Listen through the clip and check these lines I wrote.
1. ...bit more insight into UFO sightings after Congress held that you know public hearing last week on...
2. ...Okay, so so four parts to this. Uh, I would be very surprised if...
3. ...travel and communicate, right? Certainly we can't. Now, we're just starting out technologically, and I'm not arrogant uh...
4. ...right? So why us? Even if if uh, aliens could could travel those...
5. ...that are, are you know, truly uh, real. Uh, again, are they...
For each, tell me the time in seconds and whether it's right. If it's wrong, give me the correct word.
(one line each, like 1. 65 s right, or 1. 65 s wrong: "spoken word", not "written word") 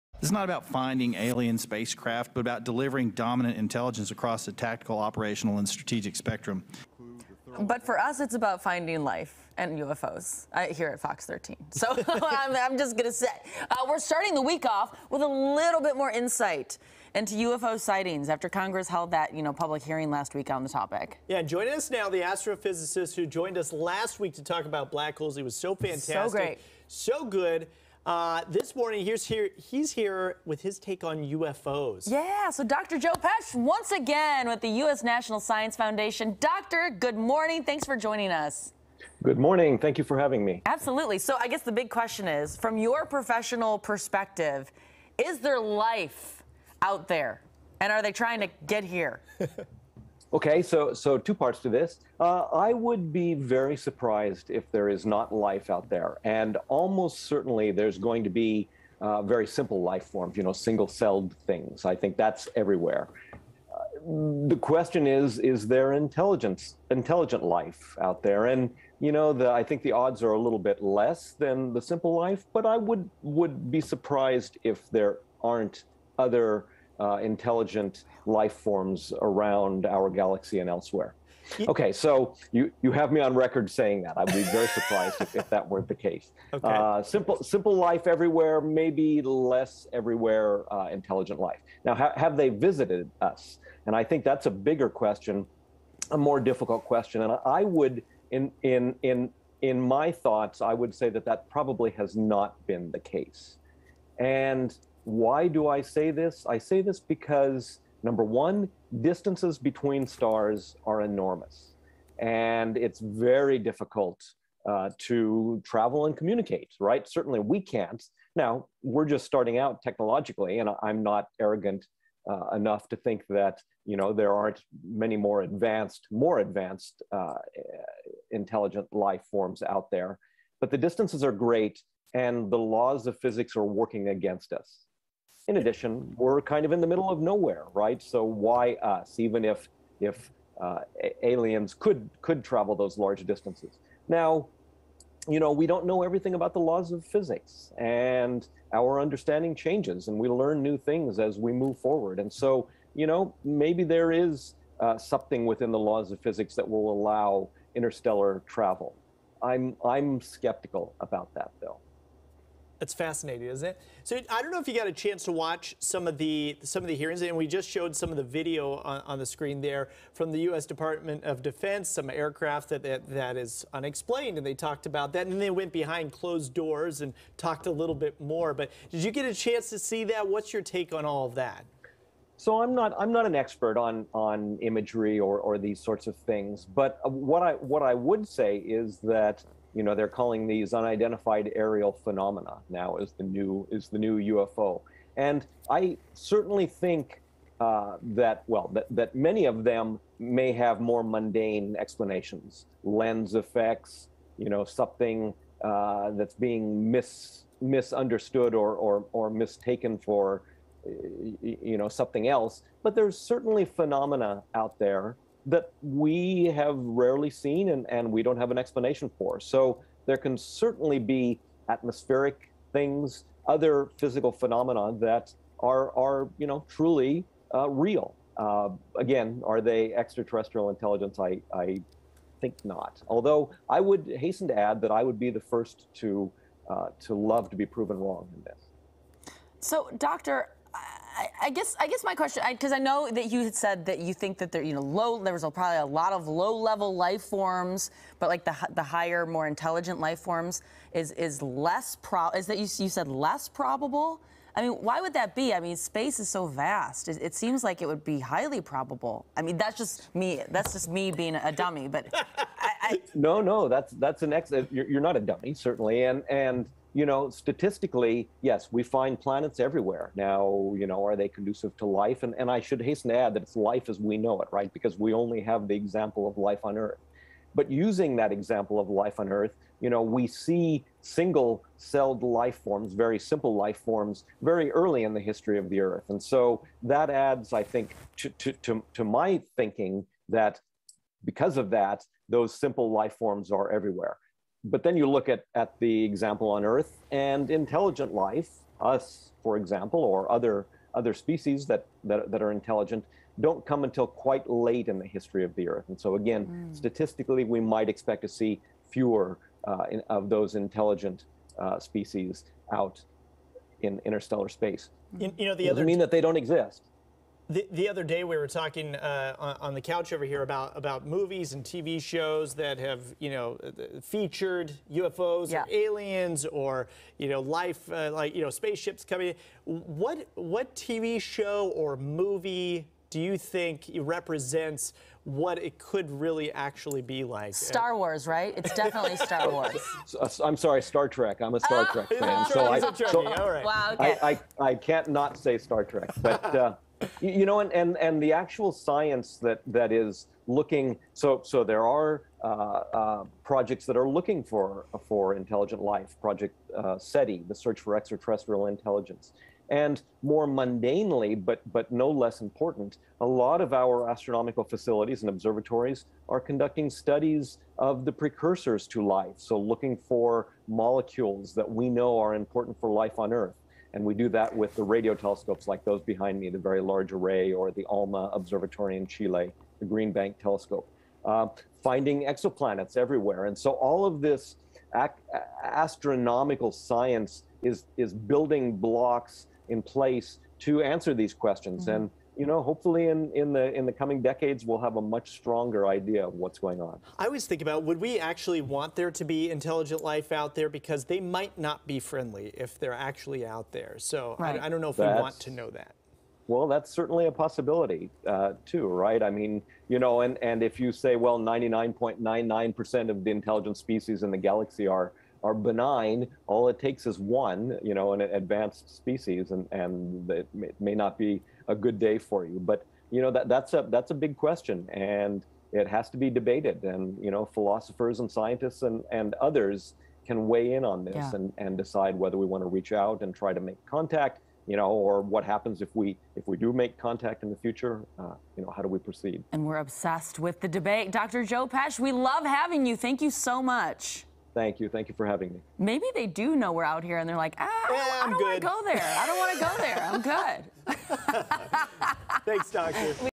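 1. 15 s right
2. 50 s wrong: "two", not "four"
3. 115 s right
4. 137 s right
5. 224 s right.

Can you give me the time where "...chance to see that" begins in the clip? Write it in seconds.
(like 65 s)
179 s.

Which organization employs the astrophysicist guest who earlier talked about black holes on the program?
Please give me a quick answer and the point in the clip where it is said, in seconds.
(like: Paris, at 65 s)
U.S. National Science Foundation, at 34 s.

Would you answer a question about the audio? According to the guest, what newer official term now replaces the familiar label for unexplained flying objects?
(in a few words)
unidentified aerial phenomena.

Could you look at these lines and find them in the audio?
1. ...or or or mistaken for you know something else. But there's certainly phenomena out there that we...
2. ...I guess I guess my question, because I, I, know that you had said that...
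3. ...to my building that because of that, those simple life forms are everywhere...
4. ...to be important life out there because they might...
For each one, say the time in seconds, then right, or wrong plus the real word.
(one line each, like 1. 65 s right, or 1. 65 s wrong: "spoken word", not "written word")
1. 208 s right
2. 241 s right
3. 288 s wrong: "thinking", not "building"
4. 399 s wrong: "intelligent", not "important".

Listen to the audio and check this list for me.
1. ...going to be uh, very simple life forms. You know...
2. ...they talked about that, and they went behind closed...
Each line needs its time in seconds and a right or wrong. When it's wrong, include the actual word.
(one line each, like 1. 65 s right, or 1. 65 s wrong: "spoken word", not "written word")
1. 57 s right
2. 174 s right.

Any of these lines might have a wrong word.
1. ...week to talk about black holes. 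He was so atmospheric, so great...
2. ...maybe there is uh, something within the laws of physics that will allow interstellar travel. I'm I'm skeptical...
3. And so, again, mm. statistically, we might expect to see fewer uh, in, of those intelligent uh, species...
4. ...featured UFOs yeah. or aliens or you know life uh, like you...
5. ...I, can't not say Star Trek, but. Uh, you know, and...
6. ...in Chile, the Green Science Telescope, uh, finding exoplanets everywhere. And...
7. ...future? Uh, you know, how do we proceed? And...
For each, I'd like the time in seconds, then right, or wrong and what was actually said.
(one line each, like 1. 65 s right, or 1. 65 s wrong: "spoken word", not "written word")
1. 24 s wrong: "fantastic", not "atmospheric"
2. 153 s right
3. 305 s right
4. 324 s right
5. 344 s right
6. 378 s wrong: "Bank", not "Science"
7. 437 s right.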